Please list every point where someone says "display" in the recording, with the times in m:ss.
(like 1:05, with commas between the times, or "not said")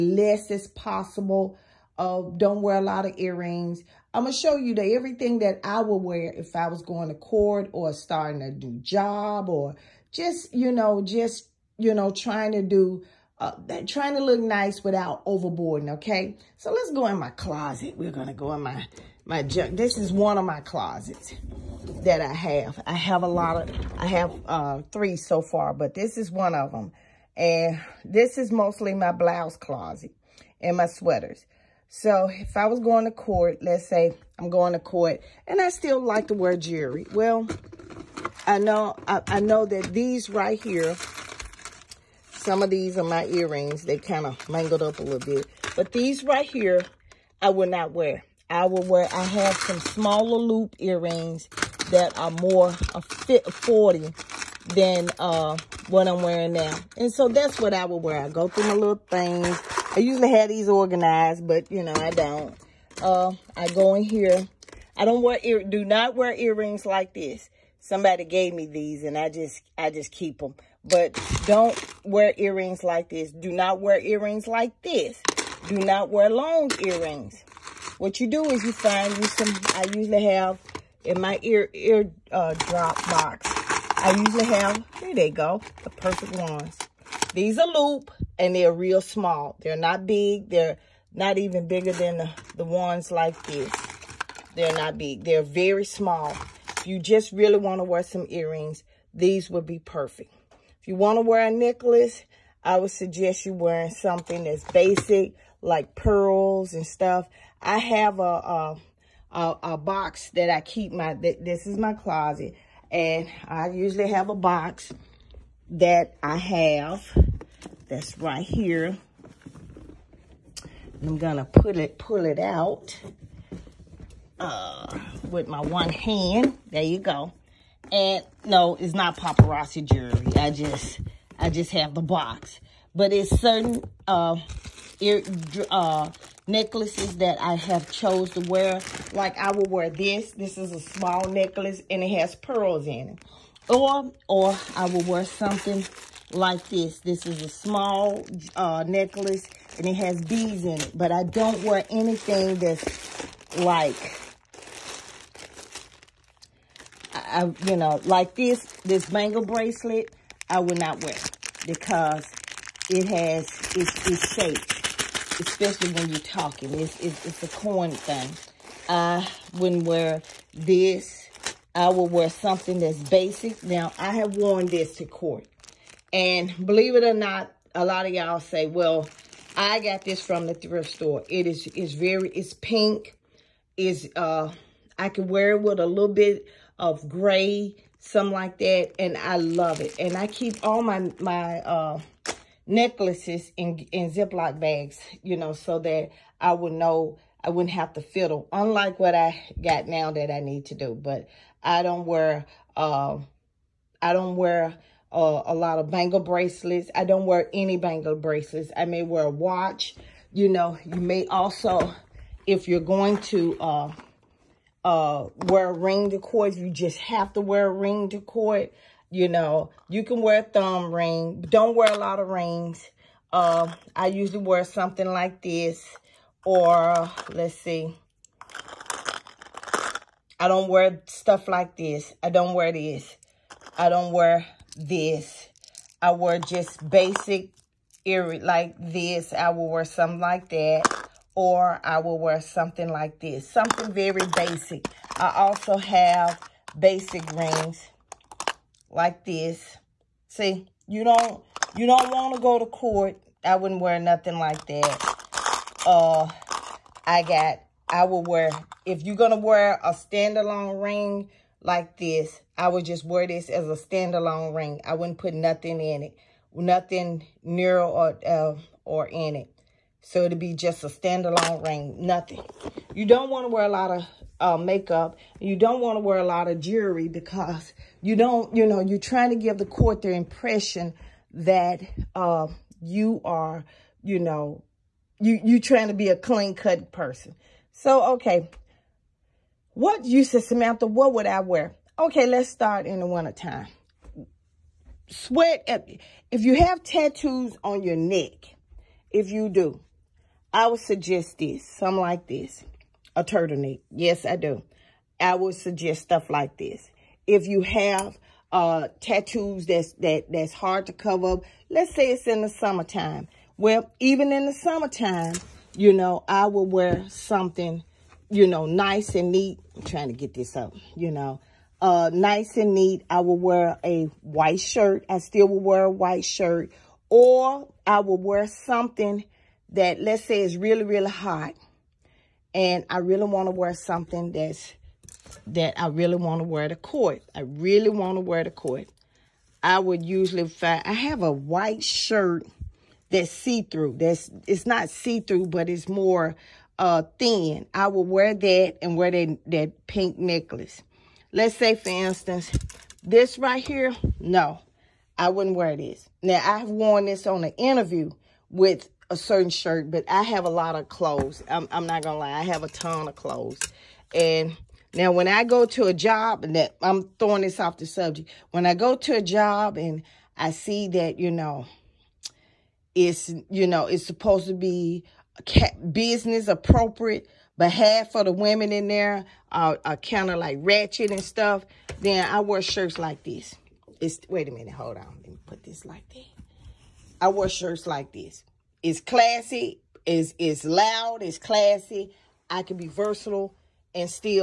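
not said.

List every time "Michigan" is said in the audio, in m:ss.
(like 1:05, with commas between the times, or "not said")
not said.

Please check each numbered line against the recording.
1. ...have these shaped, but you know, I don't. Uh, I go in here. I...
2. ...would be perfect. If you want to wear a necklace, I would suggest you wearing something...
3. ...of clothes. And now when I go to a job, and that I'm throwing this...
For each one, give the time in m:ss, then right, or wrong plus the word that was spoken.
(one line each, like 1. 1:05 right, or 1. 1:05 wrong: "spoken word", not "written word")
1. 1:00 wrong: "organized", not "shaped"
2. 1:39 right
3. 6:03 right.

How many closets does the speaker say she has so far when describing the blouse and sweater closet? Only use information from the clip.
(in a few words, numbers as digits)
3.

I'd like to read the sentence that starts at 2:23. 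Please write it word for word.
Or, or I will wear something like this.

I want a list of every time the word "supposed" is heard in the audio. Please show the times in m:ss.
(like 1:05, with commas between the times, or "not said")
6:14.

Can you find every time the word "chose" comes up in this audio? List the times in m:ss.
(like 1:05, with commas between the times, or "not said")
2:17.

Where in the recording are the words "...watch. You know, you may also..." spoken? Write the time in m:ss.
3:29.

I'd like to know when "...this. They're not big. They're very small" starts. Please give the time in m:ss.
1:33.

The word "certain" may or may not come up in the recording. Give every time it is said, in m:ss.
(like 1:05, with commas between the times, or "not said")
2:13, 5:59.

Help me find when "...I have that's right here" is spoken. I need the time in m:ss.
1:56.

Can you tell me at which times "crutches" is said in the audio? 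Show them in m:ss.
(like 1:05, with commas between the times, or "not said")
not said.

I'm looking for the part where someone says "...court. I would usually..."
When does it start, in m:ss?
5:38.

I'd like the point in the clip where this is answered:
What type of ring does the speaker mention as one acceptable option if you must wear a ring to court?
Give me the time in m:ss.
3:40.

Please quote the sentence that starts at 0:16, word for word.
So let's go in my closet.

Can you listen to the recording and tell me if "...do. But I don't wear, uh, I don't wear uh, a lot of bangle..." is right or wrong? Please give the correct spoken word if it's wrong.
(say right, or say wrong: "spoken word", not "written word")
right.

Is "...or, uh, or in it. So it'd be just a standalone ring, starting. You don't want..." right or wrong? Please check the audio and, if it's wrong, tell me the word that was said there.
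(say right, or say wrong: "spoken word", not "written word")
wrong: "nothing", not "starting".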